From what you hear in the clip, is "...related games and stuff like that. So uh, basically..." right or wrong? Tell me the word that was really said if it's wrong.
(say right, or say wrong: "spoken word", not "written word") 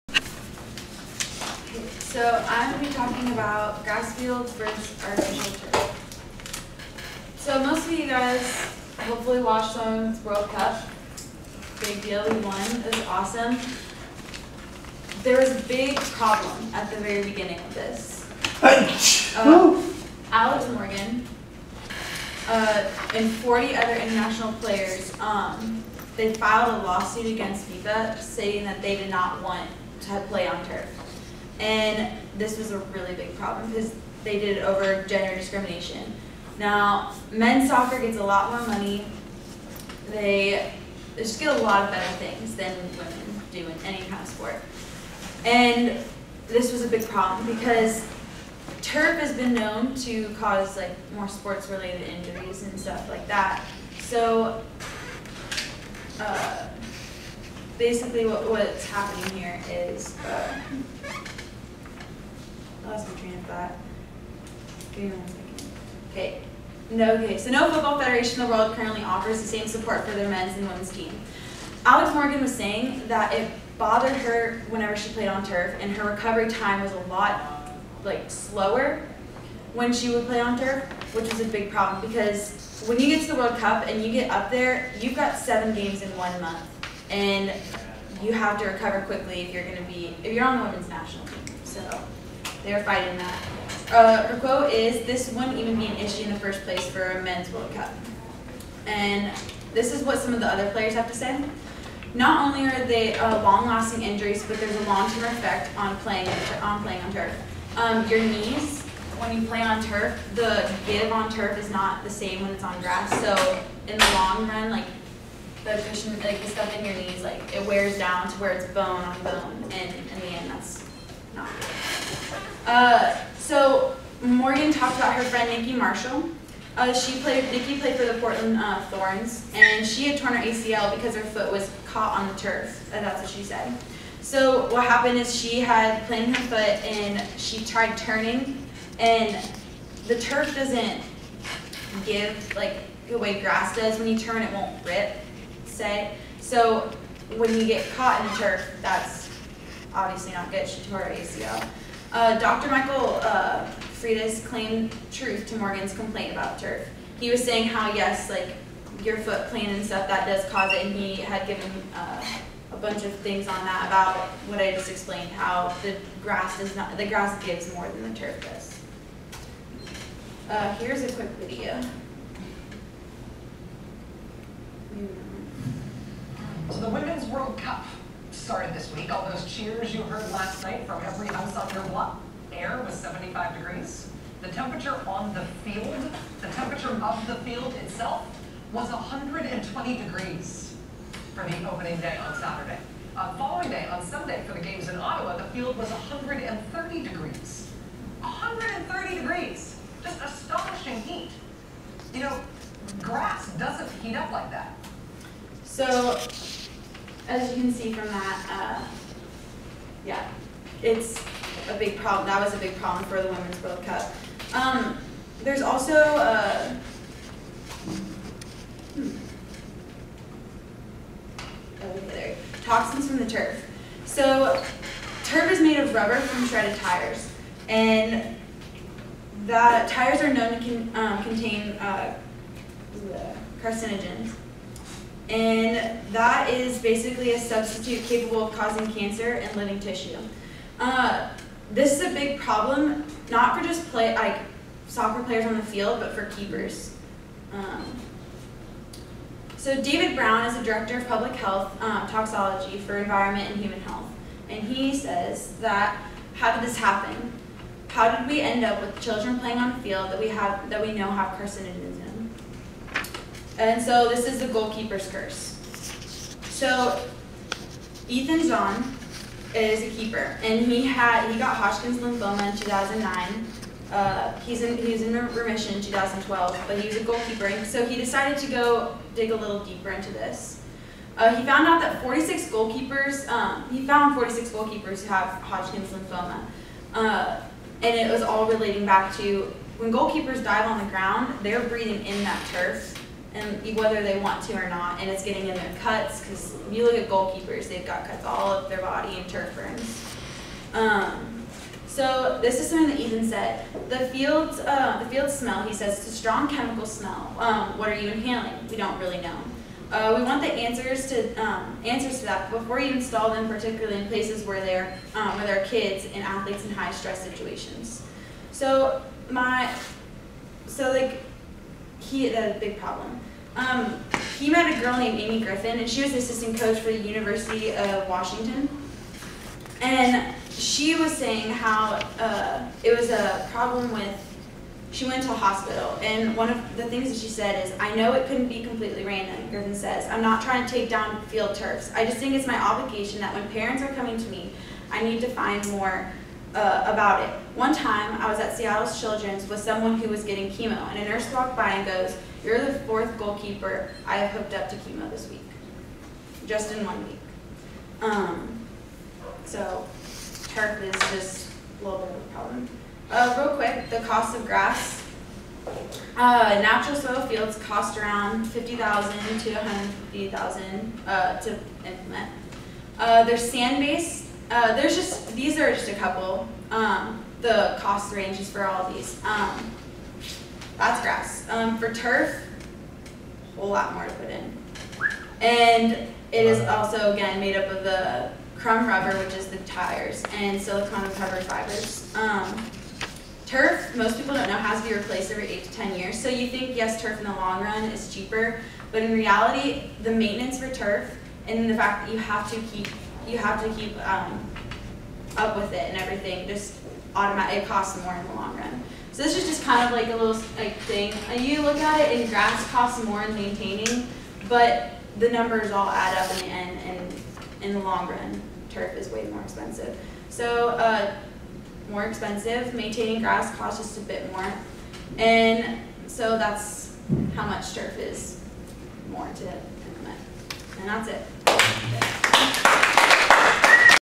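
wrong: "injuries", not "games".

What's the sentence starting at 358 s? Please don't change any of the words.
Um, so turf is just a little bit of a problem.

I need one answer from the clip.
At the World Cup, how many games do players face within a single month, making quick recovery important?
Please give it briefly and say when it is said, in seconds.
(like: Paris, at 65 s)
7, at 85 s.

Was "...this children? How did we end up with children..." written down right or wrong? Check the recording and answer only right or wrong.
wrong.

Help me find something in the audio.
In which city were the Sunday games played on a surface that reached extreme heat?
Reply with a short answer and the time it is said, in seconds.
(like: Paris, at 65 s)
Ottawa, at 194 s.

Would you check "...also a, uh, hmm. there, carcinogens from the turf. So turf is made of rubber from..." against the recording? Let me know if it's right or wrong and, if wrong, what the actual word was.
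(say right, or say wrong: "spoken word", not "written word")
wrong: "toxins", not "carcinogens".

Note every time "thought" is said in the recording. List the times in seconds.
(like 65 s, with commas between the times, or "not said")
63 s.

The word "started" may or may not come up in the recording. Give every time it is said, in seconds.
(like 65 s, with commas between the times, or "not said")
178 s.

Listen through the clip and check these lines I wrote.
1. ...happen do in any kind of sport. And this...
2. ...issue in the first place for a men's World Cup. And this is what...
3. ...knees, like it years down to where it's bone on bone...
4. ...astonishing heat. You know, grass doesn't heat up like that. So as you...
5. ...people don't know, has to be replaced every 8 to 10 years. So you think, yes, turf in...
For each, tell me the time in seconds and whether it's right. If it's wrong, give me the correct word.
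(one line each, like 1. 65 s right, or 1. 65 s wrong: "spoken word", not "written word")
1. 42 s wrong: "women", not "happen"
2. 95 s right
3. 116 s wrong: "wears", not "years"
4. 200 s right
5. 394 s right.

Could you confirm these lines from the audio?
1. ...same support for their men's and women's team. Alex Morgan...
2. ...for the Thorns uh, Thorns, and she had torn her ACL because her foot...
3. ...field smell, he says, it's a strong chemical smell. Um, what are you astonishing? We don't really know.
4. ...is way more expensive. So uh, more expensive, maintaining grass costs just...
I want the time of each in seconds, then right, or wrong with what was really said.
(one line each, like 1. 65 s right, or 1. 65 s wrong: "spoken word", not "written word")
1. 69 s right
2. 127 s wrong: "Portland", not "Thorns"
3. 305 s wrong: "inhaling", not "astonishing"
4. 418 s right.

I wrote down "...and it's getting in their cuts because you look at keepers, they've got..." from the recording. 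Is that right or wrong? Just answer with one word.
wrong.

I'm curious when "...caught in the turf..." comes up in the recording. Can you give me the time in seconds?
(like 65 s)
147 s.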